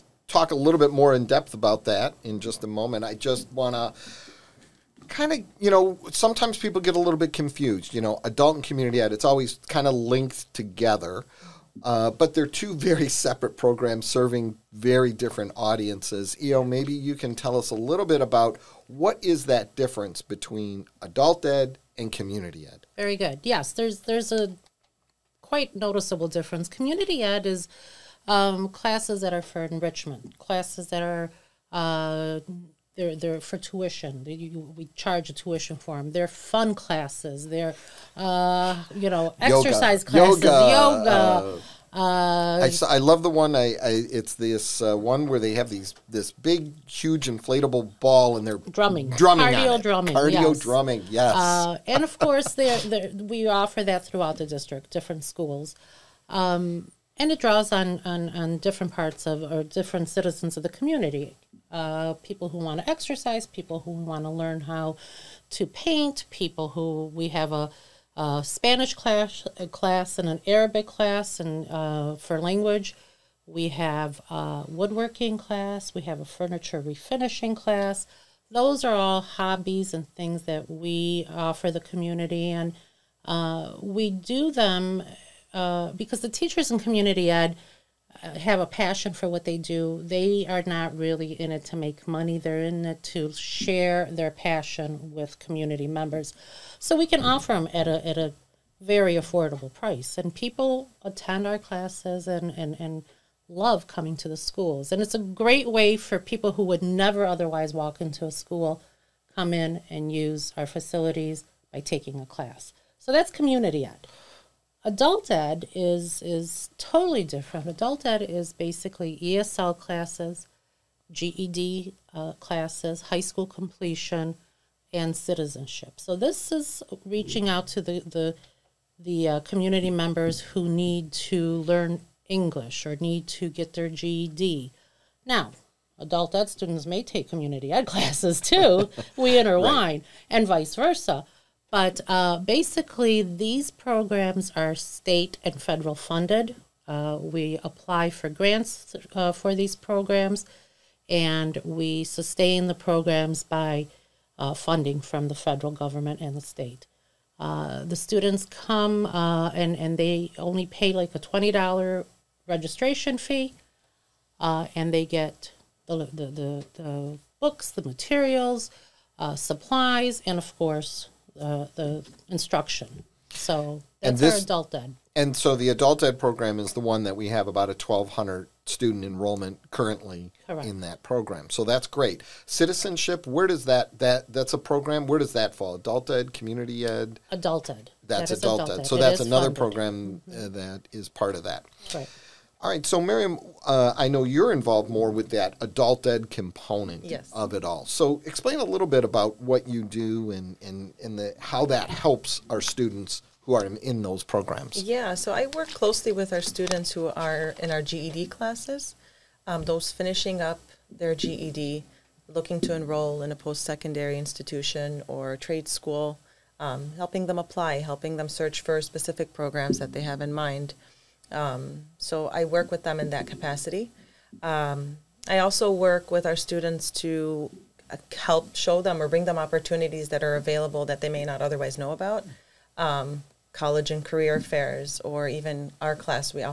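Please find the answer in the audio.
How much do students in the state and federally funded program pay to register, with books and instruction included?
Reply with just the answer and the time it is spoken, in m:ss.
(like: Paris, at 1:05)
$20, at 2:41.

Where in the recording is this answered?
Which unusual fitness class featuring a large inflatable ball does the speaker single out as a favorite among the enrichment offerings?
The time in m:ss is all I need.
0:49.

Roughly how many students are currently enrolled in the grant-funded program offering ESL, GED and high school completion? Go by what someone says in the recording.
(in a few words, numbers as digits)
1,200.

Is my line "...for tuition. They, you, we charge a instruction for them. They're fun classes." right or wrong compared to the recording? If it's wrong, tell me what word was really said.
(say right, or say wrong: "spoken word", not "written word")
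wrong: "tuition", not "instruction".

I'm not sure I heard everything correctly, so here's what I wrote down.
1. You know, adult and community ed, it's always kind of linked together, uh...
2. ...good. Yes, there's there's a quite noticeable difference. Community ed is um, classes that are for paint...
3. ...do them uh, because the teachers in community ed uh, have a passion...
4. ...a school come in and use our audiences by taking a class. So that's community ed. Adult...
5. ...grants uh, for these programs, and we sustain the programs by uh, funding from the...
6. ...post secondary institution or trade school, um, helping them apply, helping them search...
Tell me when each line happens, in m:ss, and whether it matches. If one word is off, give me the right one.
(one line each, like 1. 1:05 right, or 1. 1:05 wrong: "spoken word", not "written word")
1. 0:07 right
2. 0:23 wrong: "enrichment", not "paint"
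3. 1:24 right
4. 1:48 wrong: "facilities", not "audiences"
5. 2:28 right
6. 3:33 right.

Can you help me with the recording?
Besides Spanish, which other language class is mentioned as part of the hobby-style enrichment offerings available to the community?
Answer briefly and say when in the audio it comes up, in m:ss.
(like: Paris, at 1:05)
Arabic, at 1:10.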